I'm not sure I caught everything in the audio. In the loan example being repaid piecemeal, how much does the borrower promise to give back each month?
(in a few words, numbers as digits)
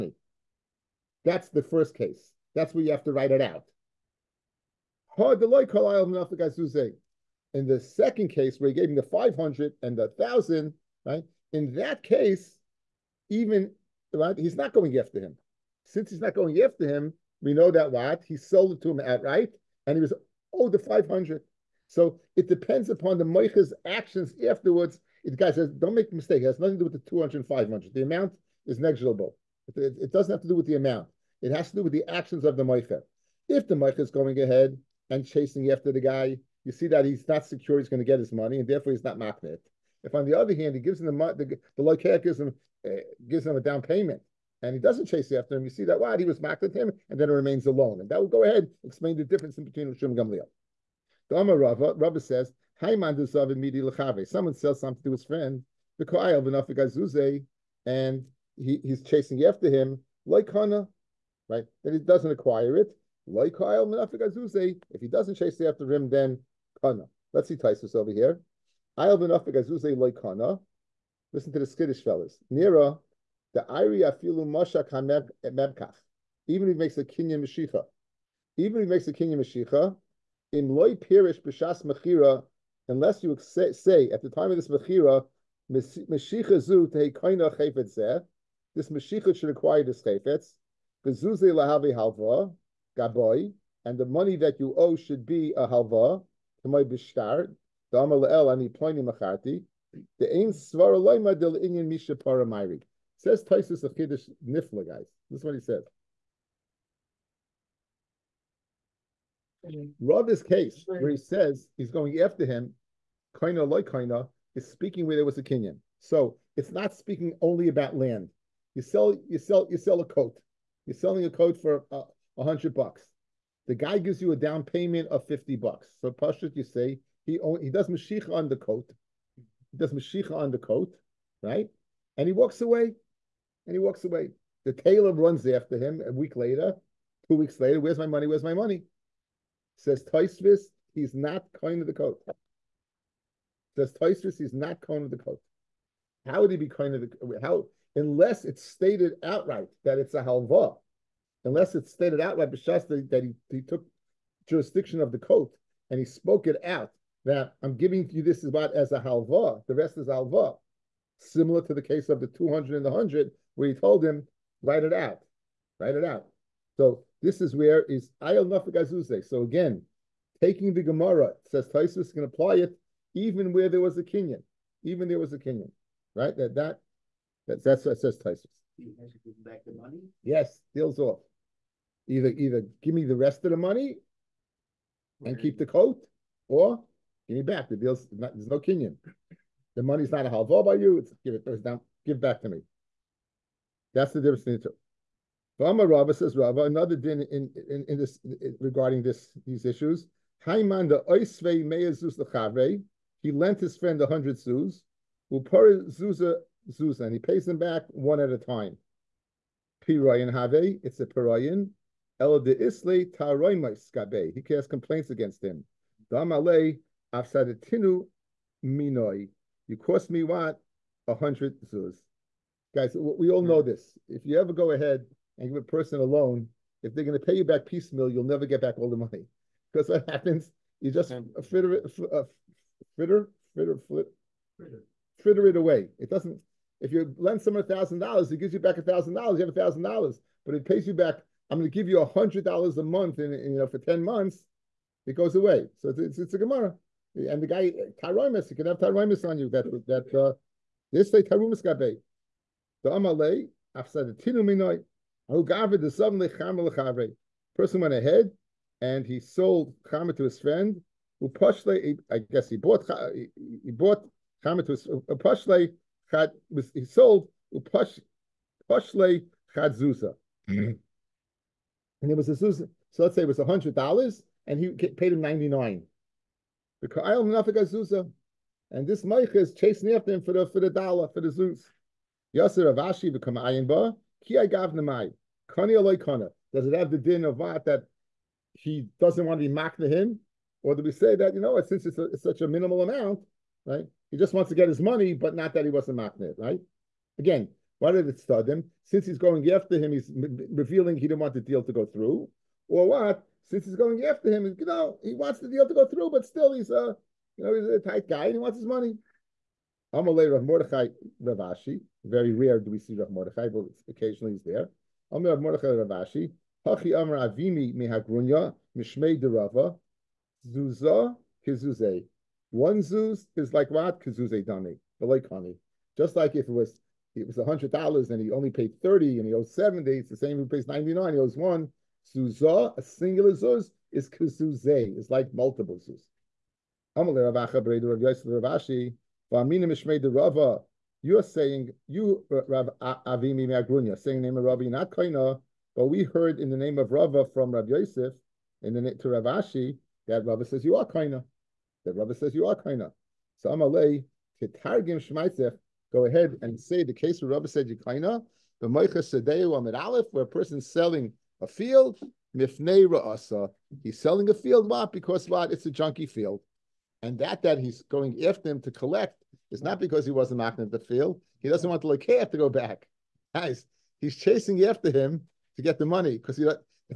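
100 dollars.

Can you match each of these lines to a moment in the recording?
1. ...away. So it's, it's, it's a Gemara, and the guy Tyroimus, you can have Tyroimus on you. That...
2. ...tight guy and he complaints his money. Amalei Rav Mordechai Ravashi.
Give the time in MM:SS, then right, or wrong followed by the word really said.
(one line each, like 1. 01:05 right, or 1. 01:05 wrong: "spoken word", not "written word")
1. 04:05 right
2. 05:07 wrong: "wants", not "complaints".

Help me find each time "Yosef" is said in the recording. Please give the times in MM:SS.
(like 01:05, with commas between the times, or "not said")
05:38, 05:47.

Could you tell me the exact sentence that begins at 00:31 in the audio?
It has to do with the actions of the moicha.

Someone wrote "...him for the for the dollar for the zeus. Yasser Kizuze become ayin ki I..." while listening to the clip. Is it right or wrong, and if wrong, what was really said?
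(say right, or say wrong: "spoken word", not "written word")
wrong: "Avashi", not "Kizuze".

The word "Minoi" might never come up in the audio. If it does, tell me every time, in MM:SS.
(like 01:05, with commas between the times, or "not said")
03:38, 04:14.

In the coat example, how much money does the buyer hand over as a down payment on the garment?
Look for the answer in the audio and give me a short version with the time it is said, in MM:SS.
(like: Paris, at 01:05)
50, at 02:05.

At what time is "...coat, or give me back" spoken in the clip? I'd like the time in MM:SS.
03:05.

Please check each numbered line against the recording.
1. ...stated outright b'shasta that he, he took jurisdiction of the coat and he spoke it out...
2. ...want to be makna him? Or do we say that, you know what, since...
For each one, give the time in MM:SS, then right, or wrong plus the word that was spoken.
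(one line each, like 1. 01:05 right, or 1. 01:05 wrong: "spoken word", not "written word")
1. 02:31 right
2. 04:49 right.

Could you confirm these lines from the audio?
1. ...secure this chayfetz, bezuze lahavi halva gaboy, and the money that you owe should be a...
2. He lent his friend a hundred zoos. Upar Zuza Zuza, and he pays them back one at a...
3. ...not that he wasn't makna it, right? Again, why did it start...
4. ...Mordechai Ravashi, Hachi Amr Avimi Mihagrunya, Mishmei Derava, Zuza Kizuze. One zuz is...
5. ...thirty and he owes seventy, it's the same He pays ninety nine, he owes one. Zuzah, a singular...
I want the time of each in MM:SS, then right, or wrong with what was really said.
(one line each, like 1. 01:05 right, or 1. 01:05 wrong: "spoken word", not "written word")
1. 01:29 wrong: "acquire", not "secure"
2. 03:23 right
3. 04:55 right
4. 05:15 right
5. 05:28 right.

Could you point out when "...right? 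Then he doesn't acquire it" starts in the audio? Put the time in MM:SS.
01:01.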